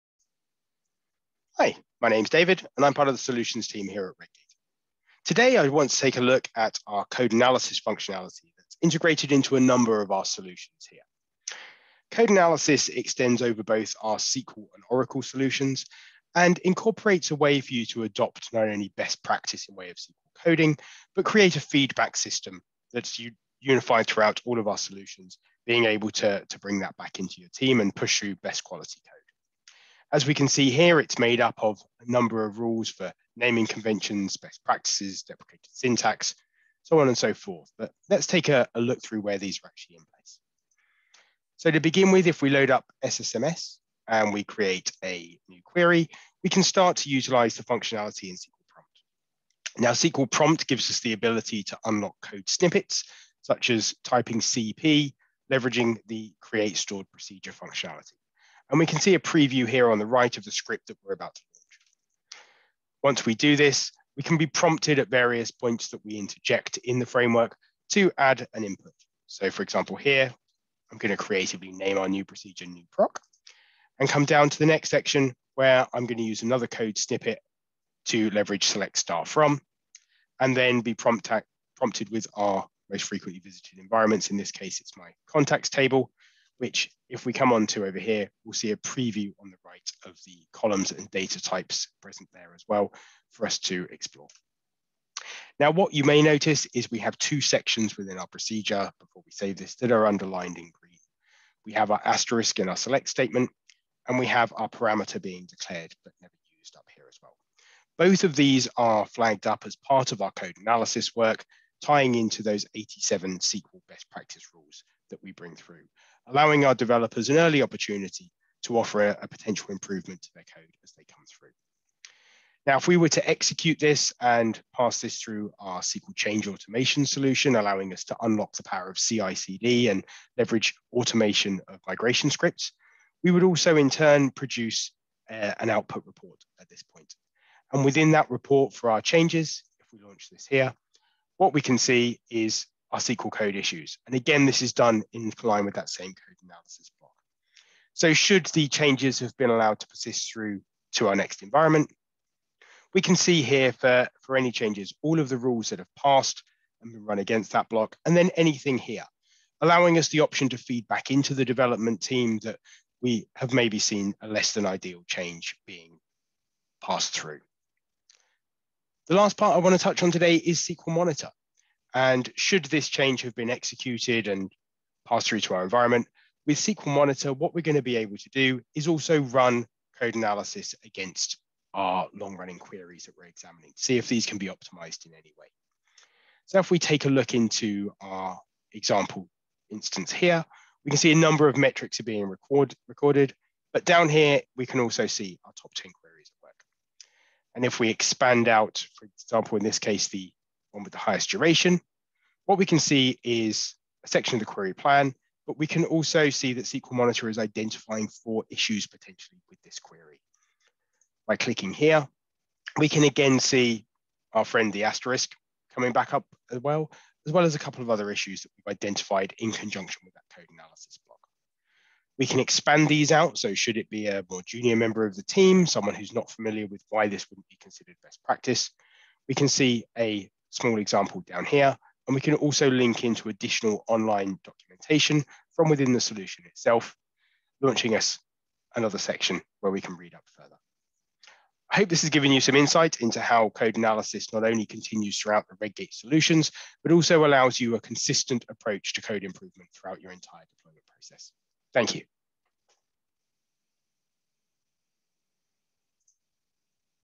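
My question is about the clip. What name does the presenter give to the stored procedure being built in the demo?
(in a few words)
new proc.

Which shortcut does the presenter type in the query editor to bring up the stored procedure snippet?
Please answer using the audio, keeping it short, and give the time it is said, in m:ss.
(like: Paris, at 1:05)
CP, at 0:54.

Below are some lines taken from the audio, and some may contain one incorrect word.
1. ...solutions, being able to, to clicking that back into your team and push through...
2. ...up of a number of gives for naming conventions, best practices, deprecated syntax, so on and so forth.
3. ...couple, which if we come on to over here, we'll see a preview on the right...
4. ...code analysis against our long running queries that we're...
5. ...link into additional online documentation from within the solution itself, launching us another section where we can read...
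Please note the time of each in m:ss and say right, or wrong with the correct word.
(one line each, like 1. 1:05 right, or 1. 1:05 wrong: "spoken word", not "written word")
1. 0:24 wrong: "bring", not "clicking"
2. 0:31 wrong: "rules", not "gives"
3. 1:25 wrong: "table", not "couple"
4. 2:59 right
5. 3:52 right.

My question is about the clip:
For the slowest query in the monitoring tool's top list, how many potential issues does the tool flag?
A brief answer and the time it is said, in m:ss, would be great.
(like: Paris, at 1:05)
4, at 3:28.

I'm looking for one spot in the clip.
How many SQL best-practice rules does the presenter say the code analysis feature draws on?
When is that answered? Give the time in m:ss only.
1:52.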